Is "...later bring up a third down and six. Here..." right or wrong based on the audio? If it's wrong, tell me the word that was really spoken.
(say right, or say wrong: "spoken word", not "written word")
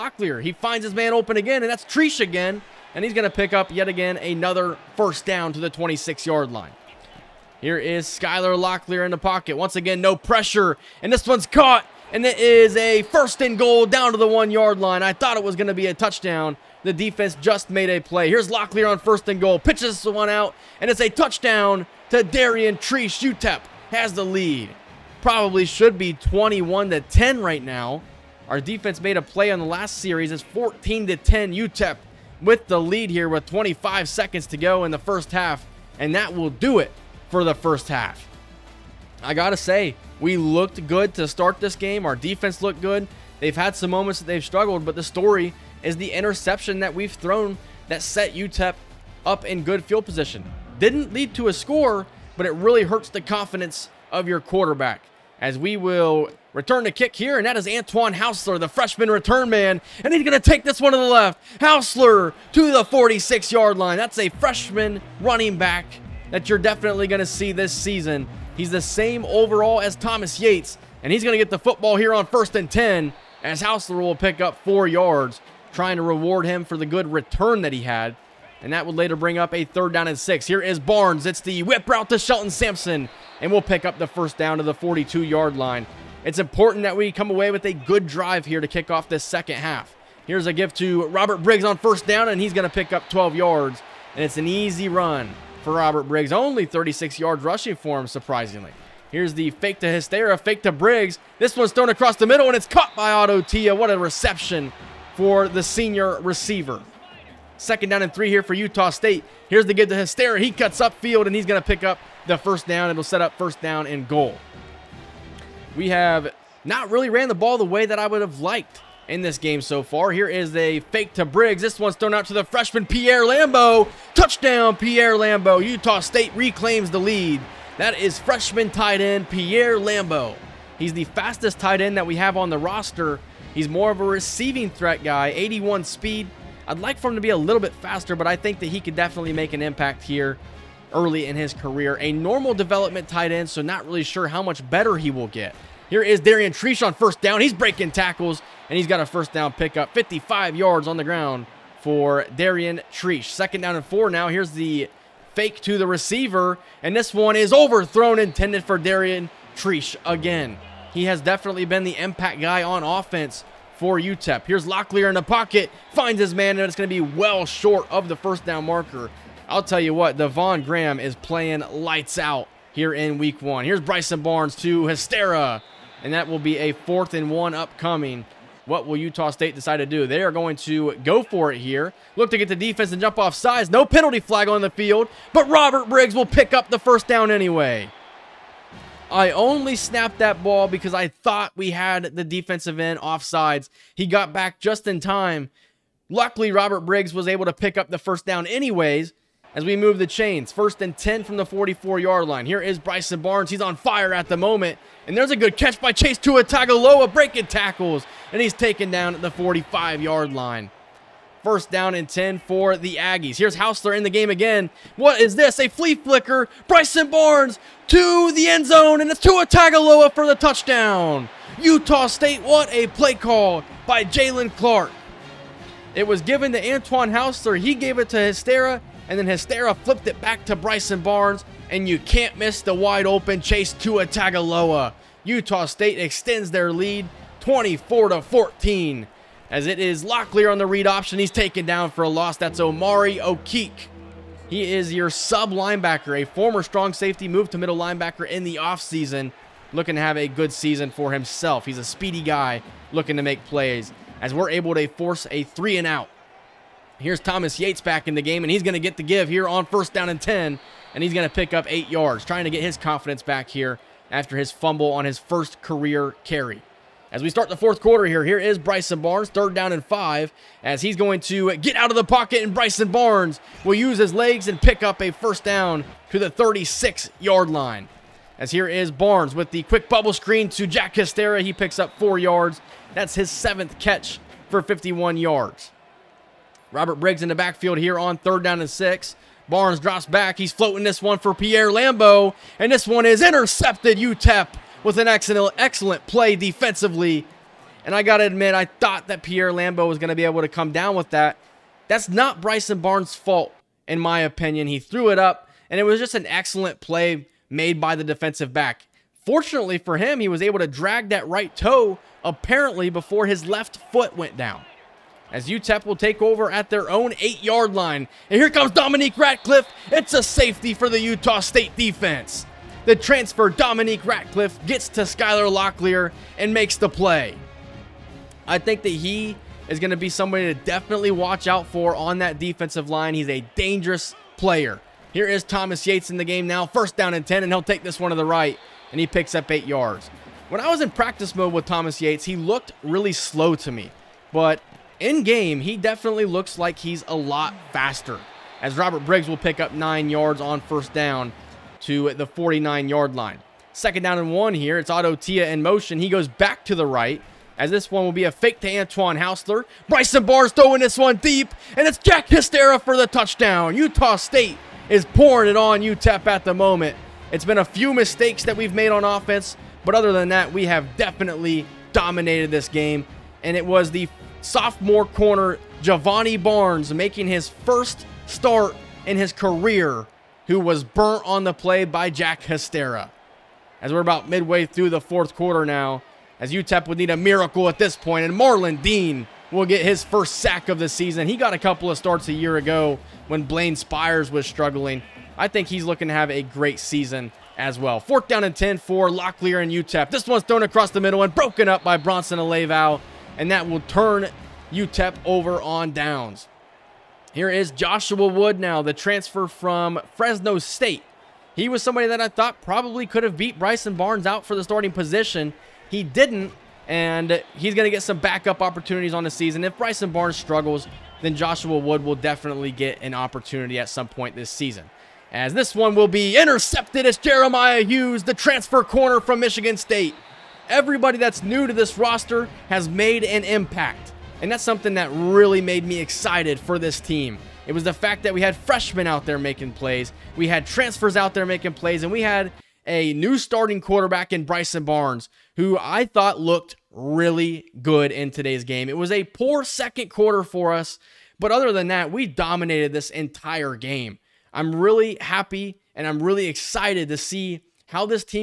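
right.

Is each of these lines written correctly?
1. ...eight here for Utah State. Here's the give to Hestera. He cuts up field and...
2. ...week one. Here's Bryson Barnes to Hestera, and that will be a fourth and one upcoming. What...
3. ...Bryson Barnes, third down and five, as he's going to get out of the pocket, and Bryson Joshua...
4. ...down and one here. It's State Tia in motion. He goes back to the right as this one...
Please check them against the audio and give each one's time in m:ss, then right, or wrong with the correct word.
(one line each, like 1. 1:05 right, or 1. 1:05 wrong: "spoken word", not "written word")
1. 1:48 wrong: "three", not "eight"
2. 2:53 right
3. 4:28 wrong: "Barnes", not "Joshua"
4. 5:54 wrong: "Otto", not "State".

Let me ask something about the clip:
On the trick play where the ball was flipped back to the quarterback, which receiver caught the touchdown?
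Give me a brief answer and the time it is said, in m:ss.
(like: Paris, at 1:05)
Chase Tagaloa, at 3:39.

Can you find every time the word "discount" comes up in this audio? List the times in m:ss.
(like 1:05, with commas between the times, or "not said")
not said.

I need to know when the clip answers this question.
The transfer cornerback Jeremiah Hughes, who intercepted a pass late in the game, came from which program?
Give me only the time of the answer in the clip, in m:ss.
7:08.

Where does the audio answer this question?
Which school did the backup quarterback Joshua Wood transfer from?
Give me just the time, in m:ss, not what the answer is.
6:48.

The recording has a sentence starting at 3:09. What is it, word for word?
I only snapped that ball because I thought we had the defensive end offsides.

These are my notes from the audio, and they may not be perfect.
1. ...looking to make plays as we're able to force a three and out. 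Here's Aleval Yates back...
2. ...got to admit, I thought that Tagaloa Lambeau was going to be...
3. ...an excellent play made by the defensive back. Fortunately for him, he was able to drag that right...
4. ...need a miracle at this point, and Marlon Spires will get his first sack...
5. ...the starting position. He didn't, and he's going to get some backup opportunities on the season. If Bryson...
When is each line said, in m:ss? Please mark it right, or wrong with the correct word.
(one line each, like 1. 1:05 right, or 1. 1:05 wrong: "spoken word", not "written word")
1. 4:12 wrong: "Thomas", not "Aleval"
2. 4:58 wrong: "Pierre", not "Tagaloa"
3. 5:06 right
4. 6:26 wrong: "Dean", not "Spires"
5. 6:54 right.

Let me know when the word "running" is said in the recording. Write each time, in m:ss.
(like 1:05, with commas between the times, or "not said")
1:05.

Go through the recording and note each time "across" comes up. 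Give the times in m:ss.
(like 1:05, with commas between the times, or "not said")
1:41, 6:40.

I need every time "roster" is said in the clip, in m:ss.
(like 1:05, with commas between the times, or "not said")
2:12, 7:11.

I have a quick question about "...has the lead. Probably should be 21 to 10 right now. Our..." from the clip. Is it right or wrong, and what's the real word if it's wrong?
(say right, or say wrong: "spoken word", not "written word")
right.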